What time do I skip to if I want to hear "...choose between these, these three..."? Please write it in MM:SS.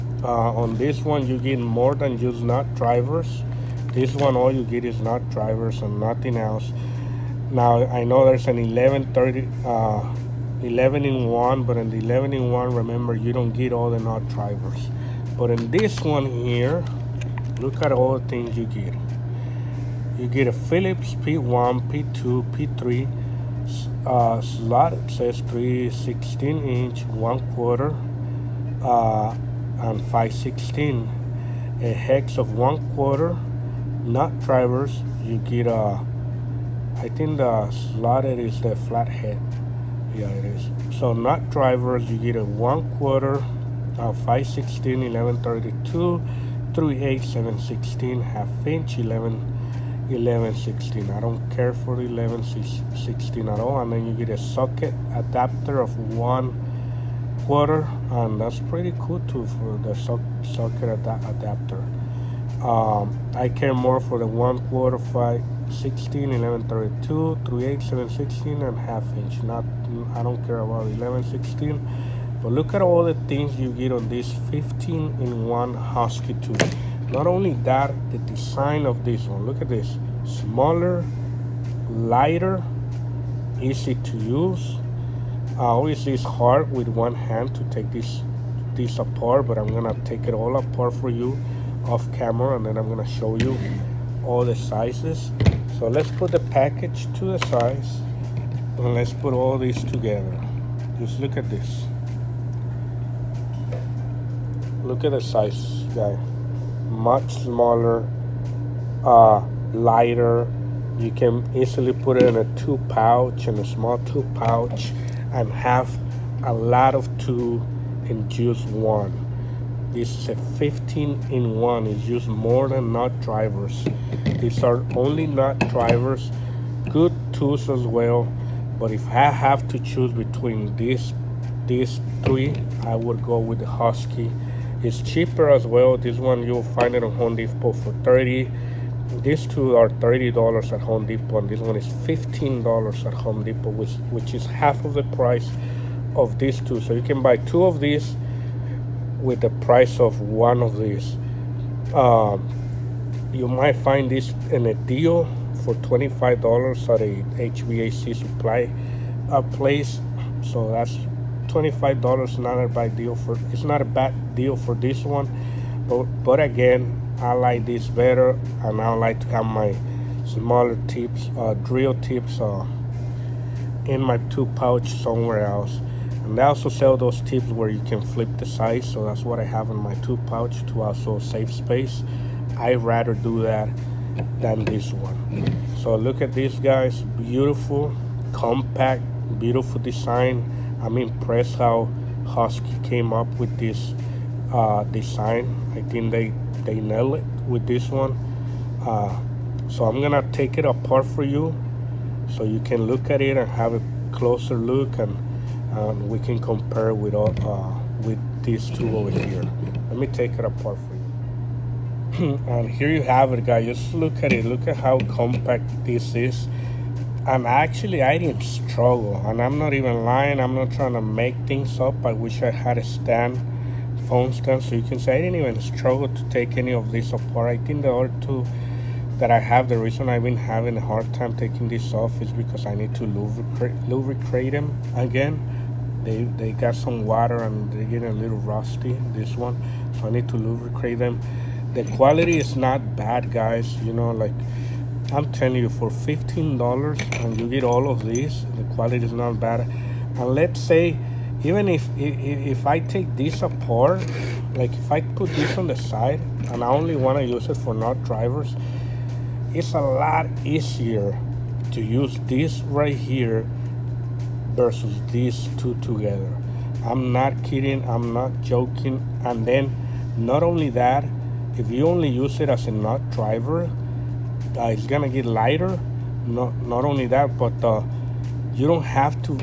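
02:09.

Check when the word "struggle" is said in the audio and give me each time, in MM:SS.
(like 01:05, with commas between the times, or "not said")
03:38, 03:45.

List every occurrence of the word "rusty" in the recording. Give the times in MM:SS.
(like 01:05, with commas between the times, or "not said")
03:58.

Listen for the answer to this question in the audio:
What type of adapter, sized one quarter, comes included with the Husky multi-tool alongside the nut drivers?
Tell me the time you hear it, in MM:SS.
00:54.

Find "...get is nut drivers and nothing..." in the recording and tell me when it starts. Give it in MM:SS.
00:04.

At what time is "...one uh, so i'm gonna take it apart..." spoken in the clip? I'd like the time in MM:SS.
03:17.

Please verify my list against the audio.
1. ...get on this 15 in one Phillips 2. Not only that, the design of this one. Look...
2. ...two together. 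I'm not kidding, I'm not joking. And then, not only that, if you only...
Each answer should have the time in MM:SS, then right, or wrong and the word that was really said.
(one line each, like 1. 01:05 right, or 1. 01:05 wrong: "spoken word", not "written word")
1. 01:13 wrong: "Husky", not "Phillips"
2. 04:25 right.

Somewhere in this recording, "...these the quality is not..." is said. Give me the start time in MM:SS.
04:08.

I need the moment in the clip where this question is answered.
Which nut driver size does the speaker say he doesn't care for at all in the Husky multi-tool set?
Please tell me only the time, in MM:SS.
00:51.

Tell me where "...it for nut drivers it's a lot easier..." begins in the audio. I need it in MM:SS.
04:17.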